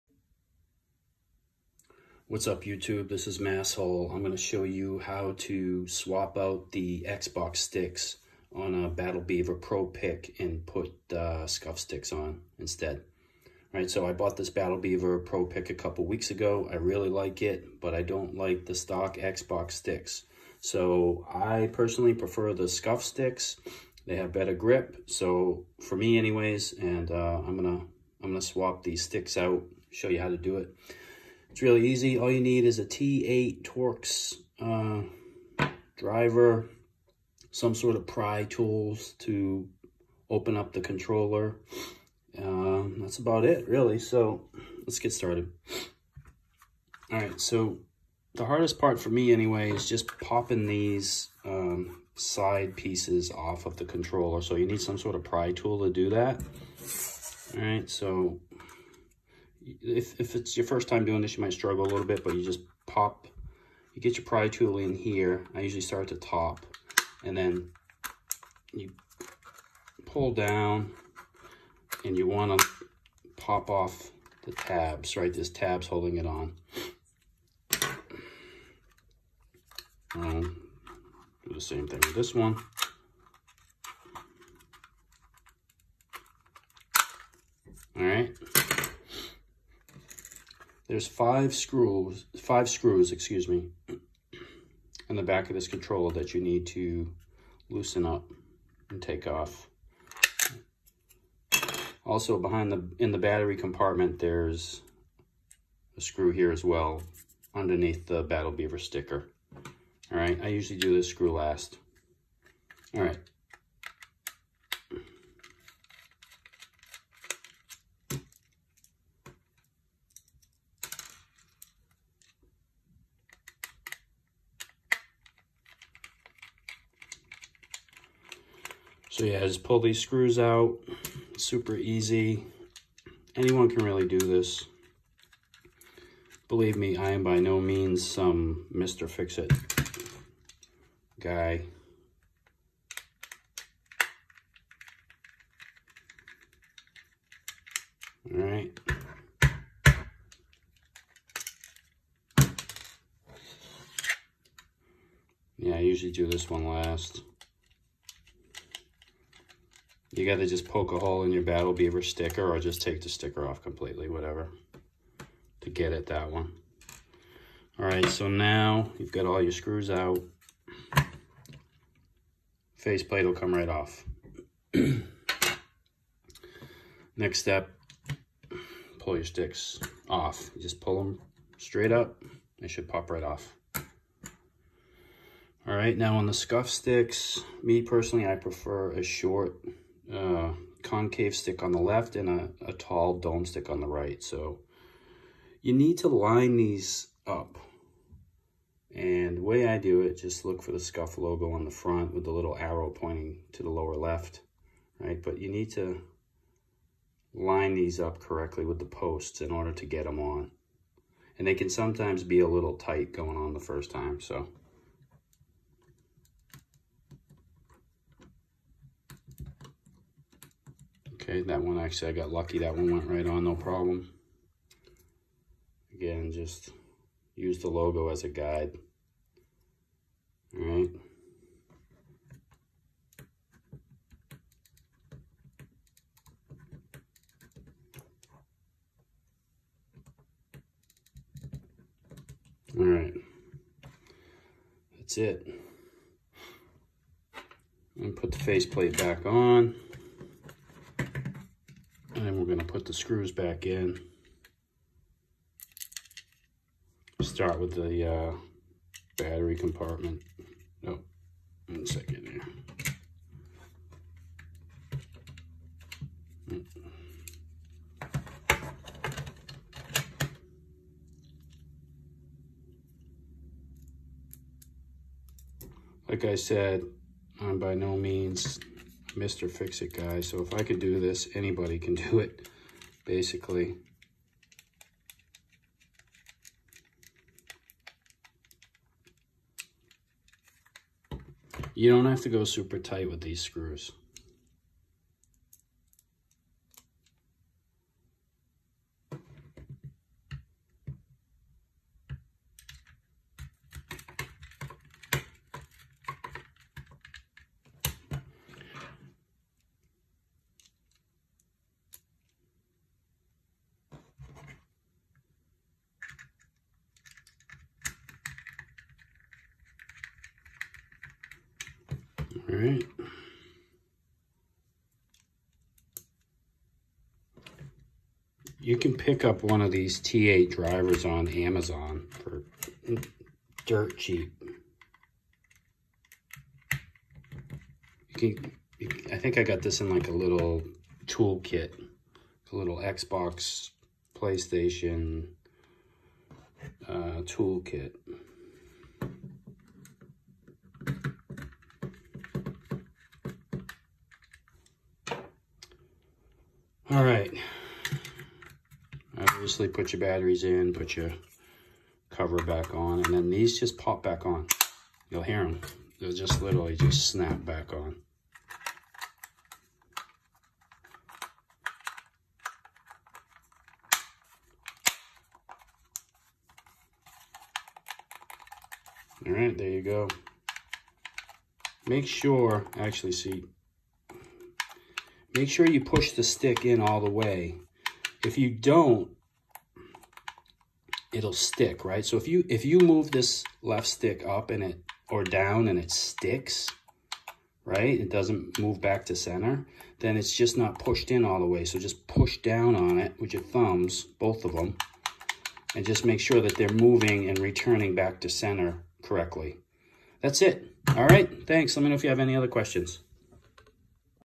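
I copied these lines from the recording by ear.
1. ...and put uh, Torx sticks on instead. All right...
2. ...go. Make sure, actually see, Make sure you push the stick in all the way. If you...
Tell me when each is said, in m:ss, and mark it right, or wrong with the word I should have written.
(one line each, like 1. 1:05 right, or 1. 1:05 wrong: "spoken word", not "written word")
1. 0:10 wrong: "Scuf", not "Torx"
2. 6:19 right.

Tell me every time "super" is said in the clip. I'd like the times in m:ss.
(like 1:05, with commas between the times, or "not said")
2:11, 4:52.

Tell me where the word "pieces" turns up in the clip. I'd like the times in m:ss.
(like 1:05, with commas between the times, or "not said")
0:52.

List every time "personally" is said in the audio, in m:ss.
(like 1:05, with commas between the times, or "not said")
0:21, 3:07.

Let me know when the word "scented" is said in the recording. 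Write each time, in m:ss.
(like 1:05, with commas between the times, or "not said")
not said.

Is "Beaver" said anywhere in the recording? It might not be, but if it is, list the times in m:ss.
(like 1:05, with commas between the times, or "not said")
0:09, 0:14, 1:48, 2:41.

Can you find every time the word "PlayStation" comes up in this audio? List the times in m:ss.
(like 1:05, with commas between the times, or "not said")
5:44.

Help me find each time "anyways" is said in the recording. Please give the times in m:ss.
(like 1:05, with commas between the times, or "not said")
0:26, 0:49.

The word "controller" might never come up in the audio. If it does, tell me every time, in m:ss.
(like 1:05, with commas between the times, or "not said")
0:40, 0:53, 1:35.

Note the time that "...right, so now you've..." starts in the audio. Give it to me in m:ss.
2:47.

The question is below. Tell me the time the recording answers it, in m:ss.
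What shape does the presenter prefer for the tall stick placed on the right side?
3:13.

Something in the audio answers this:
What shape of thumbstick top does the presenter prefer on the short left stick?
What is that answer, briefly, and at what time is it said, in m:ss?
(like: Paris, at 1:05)
concave, at 3:10.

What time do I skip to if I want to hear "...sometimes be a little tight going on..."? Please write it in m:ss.
3:31.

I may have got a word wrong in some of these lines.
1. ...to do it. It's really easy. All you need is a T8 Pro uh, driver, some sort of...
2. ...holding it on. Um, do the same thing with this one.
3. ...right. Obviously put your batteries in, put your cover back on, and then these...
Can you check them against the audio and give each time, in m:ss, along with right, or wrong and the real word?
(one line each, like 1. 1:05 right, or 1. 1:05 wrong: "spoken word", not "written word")
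1. 0:30 wrong: "Torx", not "Pro"
2. 1:15 right
3. 5:57 right.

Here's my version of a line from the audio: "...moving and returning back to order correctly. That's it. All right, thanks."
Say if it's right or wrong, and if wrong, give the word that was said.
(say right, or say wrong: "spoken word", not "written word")
wrong: "center", not "order".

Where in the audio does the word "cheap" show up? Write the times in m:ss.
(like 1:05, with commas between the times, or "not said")
5:33.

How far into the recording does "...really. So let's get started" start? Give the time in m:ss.
0:43.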